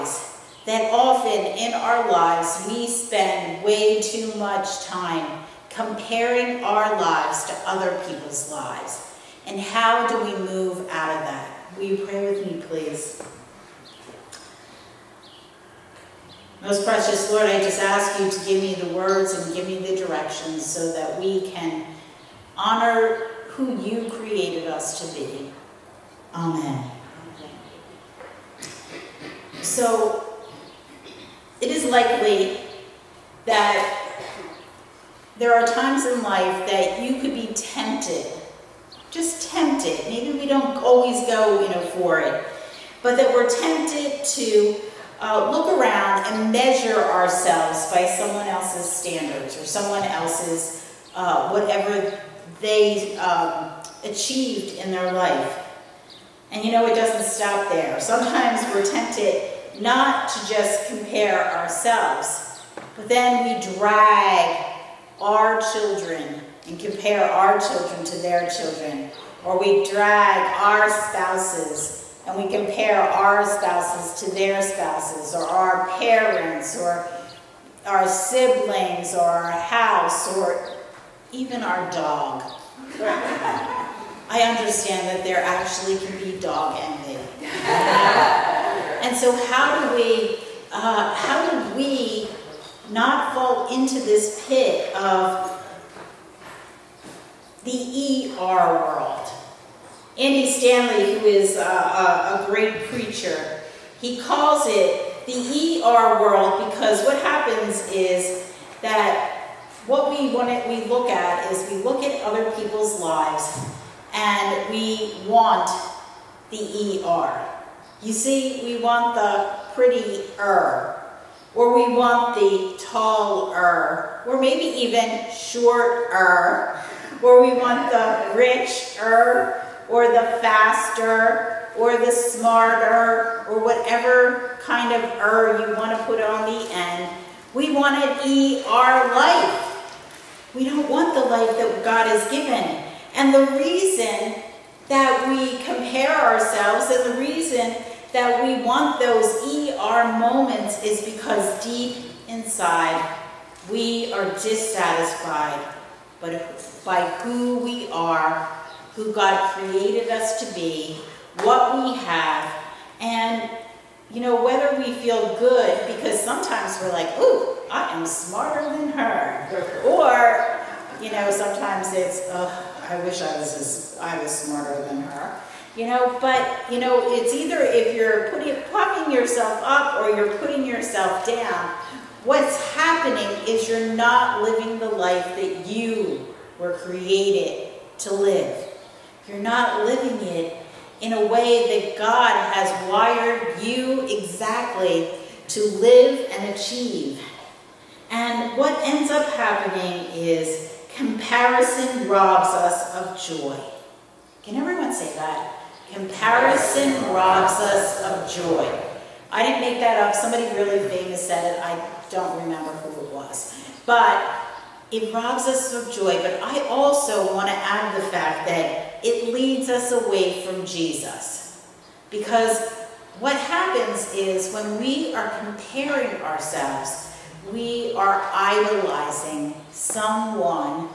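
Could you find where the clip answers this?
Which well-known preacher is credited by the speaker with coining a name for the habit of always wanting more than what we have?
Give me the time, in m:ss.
1:40.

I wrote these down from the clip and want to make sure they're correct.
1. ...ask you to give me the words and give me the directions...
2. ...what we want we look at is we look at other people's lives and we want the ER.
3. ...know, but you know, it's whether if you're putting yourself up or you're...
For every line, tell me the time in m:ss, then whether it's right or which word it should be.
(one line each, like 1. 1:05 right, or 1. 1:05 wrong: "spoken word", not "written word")
1. 0:17 right
2. 1:49 right
3. 2:55 wrong: "either", not "whether".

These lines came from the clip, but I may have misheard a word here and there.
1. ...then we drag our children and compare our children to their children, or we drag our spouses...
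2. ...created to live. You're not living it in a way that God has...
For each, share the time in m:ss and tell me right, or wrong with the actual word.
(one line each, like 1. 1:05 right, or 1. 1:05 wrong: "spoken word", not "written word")
1. 1:03 right
2. 3:06 right.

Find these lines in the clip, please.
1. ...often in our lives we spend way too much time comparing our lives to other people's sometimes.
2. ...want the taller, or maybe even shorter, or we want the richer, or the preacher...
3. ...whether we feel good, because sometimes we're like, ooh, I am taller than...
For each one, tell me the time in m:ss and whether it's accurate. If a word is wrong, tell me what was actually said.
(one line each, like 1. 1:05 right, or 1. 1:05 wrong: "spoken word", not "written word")
1. 0:00 wrong: "lives", not "sometimes"
2. 2:01 wrong: "faster", not "preacher"
3. 2:44 wrong: "smarter", not "taller".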